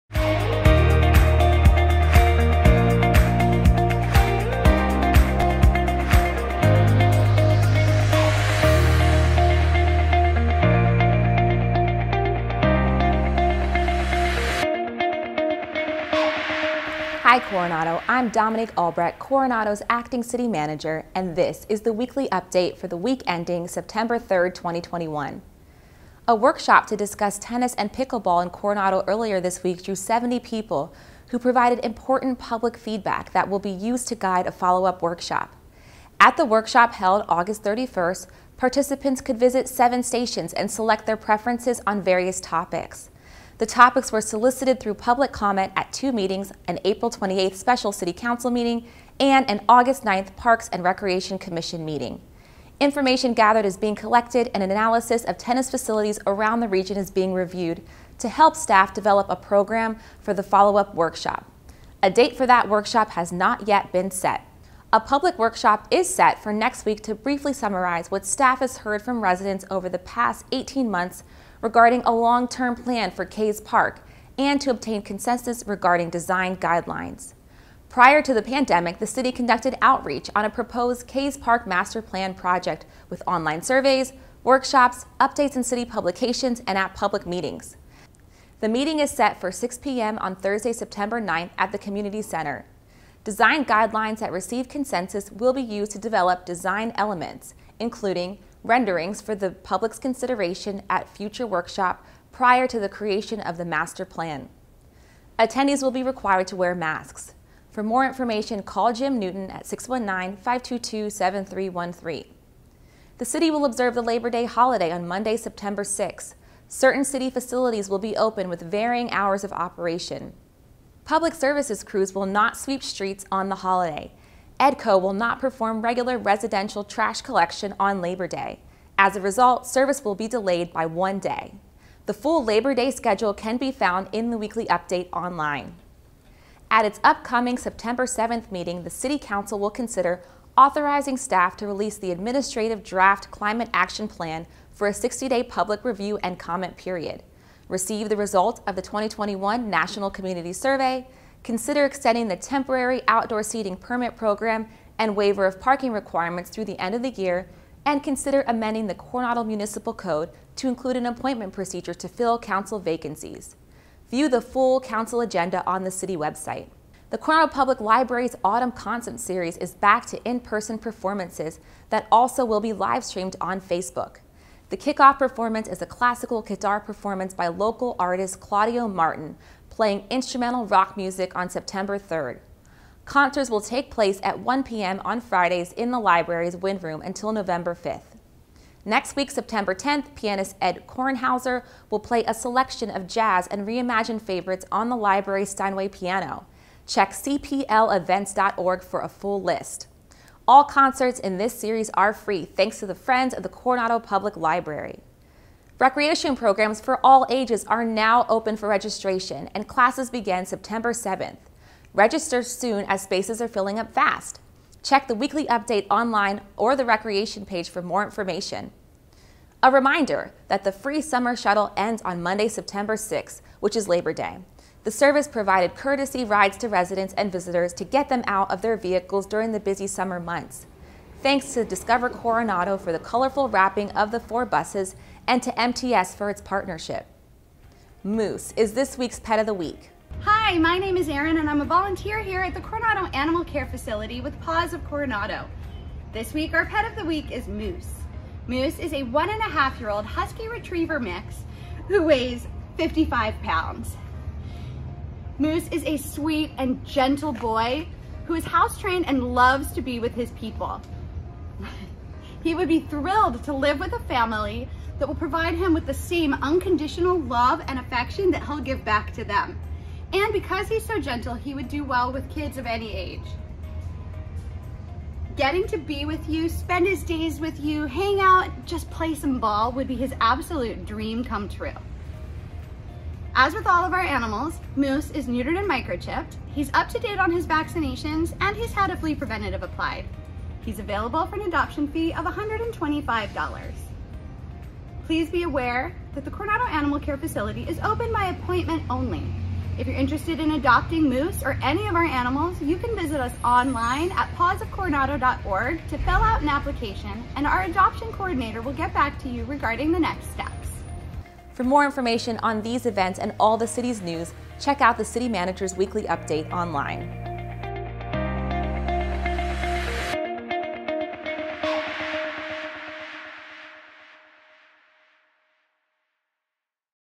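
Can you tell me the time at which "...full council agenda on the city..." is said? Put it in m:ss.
2:44.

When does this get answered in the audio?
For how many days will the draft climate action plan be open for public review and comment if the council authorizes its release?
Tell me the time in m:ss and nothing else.
2:24.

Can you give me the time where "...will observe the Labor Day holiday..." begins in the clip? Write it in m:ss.
1:53.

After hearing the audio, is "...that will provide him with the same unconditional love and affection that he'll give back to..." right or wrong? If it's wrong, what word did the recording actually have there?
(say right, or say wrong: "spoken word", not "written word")
right.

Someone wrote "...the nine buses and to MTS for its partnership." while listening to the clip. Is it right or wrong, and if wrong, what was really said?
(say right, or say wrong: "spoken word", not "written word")
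wrong: "four", not "nine".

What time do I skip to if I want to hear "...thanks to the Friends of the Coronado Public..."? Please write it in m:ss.
3:22.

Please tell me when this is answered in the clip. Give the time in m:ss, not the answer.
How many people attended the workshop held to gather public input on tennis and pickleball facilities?
0:29.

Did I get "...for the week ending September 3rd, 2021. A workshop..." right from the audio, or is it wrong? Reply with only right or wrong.
right.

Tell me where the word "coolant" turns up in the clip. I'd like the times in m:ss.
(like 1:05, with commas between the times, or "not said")
not said.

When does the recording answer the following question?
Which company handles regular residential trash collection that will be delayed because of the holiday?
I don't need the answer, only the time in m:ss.
2:04.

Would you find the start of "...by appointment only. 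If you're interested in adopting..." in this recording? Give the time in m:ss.
4:58.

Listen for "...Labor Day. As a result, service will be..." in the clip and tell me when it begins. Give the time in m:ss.
2:07.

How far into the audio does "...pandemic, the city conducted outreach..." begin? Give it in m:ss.
1:18.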